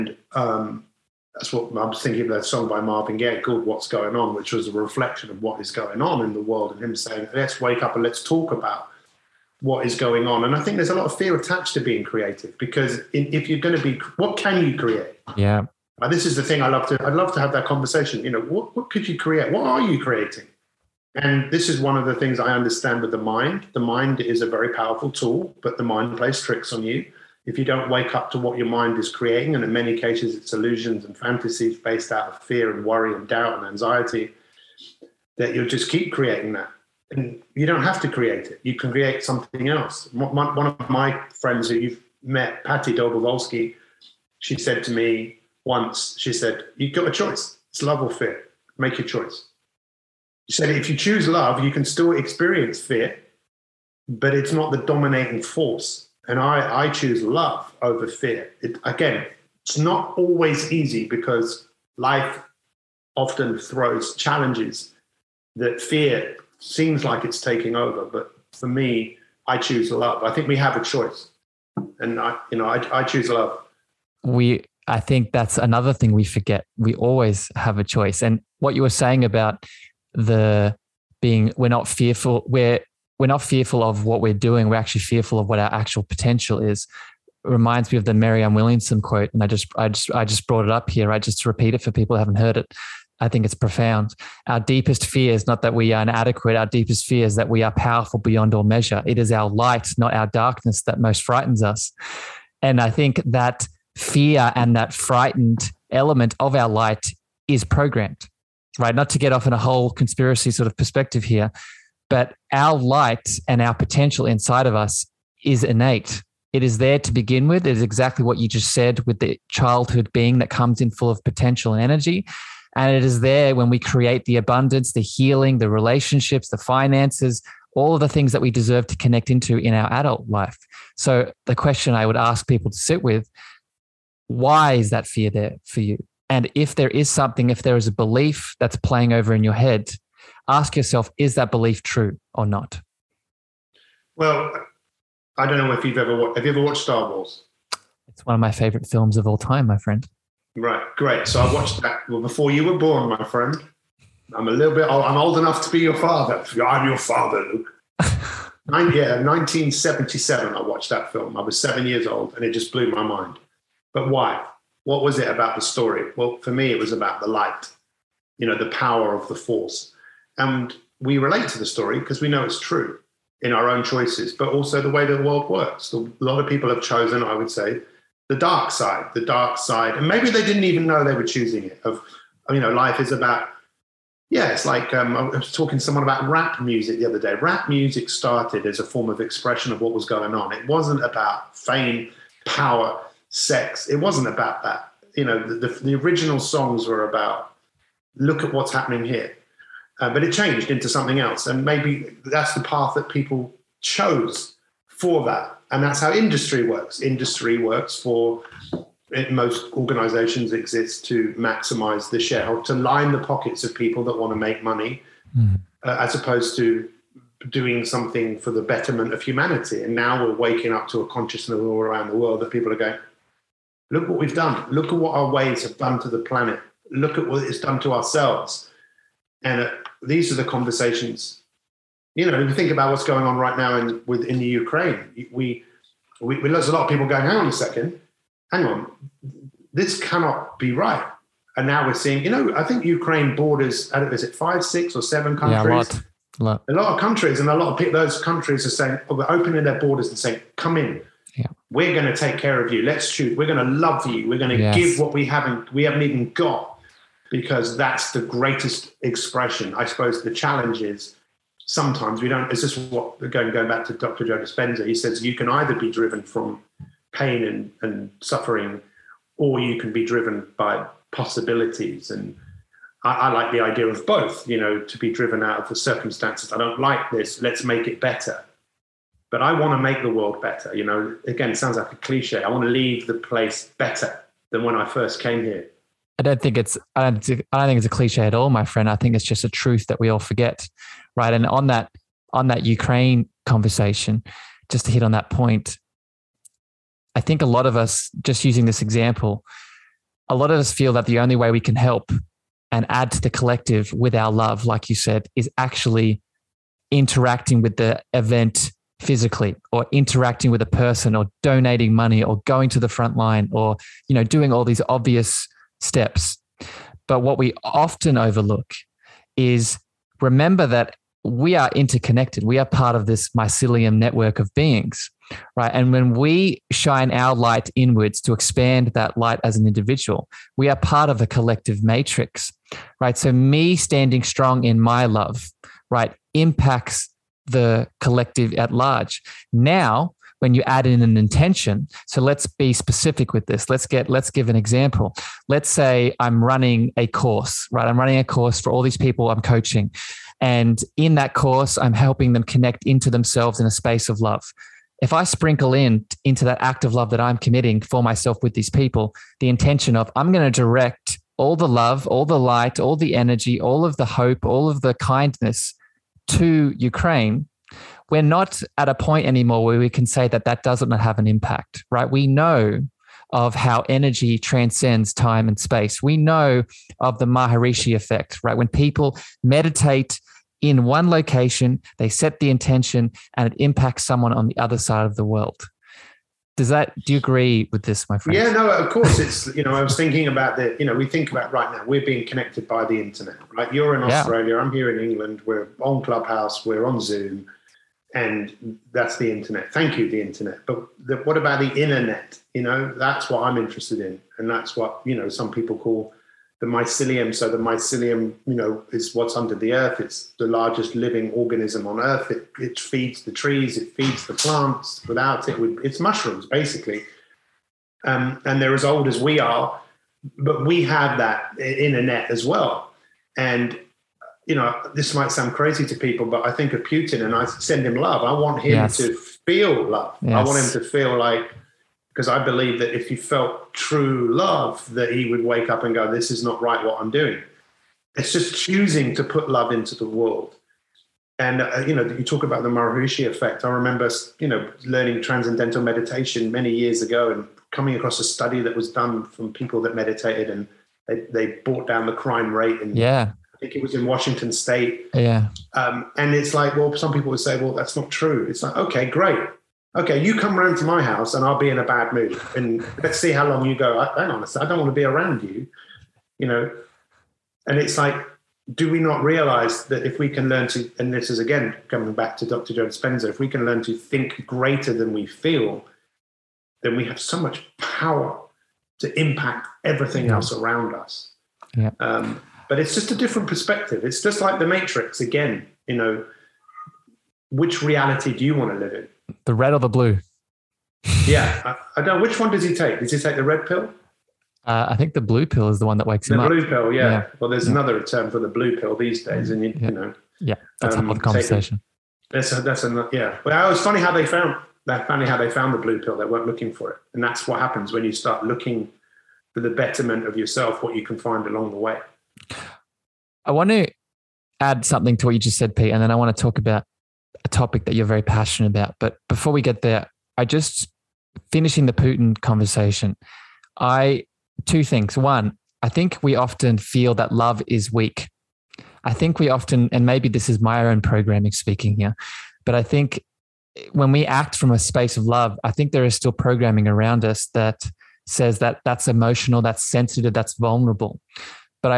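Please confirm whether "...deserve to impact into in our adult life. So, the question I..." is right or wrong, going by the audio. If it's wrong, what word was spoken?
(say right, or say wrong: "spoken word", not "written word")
wrong: "connect", not "impact".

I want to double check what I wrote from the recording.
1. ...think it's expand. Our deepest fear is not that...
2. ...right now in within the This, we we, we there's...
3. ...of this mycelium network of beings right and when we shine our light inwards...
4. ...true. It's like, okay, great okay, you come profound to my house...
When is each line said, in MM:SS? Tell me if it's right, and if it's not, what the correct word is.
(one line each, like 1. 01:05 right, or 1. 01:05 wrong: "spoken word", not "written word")
1. 01:33 wrong: "profound", not "expand"
2. 03:53 wrong: "Ukraine", not "This"
3. 05:22 right
4. 07:38 wrong: "round", not "profound".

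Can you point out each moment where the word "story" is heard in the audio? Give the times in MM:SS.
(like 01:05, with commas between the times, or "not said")
02:45, 02:51.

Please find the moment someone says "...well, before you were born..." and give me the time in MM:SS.
02:32.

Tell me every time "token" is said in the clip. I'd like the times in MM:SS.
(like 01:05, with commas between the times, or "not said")
not said.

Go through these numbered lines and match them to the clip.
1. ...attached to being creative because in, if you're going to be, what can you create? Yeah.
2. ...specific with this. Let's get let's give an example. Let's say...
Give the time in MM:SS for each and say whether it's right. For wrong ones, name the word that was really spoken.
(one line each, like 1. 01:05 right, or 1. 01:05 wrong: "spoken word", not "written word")
1. 00:11 right
2. 05:42 right.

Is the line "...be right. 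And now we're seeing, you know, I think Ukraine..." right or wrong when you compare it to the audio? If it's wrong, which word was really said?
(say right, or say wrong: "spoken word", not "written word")
right.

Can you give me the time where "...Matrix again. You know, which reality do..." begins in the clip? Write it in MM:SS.
08:04.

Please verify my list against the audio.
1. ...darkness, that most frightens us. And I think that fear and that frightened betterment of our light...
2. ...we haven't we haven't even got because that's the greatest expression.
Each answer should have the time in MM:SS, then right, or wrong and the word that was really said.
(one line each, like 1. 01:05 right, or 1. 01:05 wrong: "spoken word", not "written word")
1. 01:40 wrong: "element", not "betterment"
2. 04:15 right.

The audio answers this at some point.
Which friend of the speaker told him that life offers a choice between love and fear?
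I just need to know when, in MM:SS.
00:42.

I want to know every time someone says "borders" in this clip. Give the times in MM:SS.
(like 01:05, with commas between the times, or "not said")
04:03, 04:09.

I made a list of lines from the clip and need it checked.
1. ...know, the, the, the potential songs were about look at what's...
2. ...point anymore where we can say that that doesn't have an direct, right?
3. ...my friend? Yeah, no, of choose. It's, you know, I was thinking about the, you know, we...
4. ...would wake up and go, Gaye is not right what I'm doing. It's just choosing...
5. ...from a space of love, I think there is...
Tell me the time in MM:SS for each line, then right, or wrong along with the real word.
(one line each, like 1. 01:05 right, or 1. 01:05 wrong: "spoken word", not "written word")
1. 03:15 wrong: "original", not "potential"
2. 06:08 wrong: "impact", not "direct"
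3. 06:28 wrong: "course", not "choose"
4. 07:15 wrong: "This", not "Gaye"
5. 08:54 right.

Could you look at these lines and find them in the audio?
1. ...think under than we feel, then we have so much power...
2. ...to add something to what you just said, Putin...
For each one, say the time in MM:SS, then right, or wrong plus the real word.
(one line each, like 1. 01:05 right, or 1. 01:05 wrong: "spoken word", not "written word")
1. 07:53 wrong: "greater", not "under"
2. 08:33 wrong: "Pete", not "Putin".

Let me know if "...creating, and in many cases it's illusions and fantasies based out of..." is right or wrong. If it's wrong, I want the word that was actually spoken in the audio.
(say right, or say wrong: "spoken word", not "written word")
right.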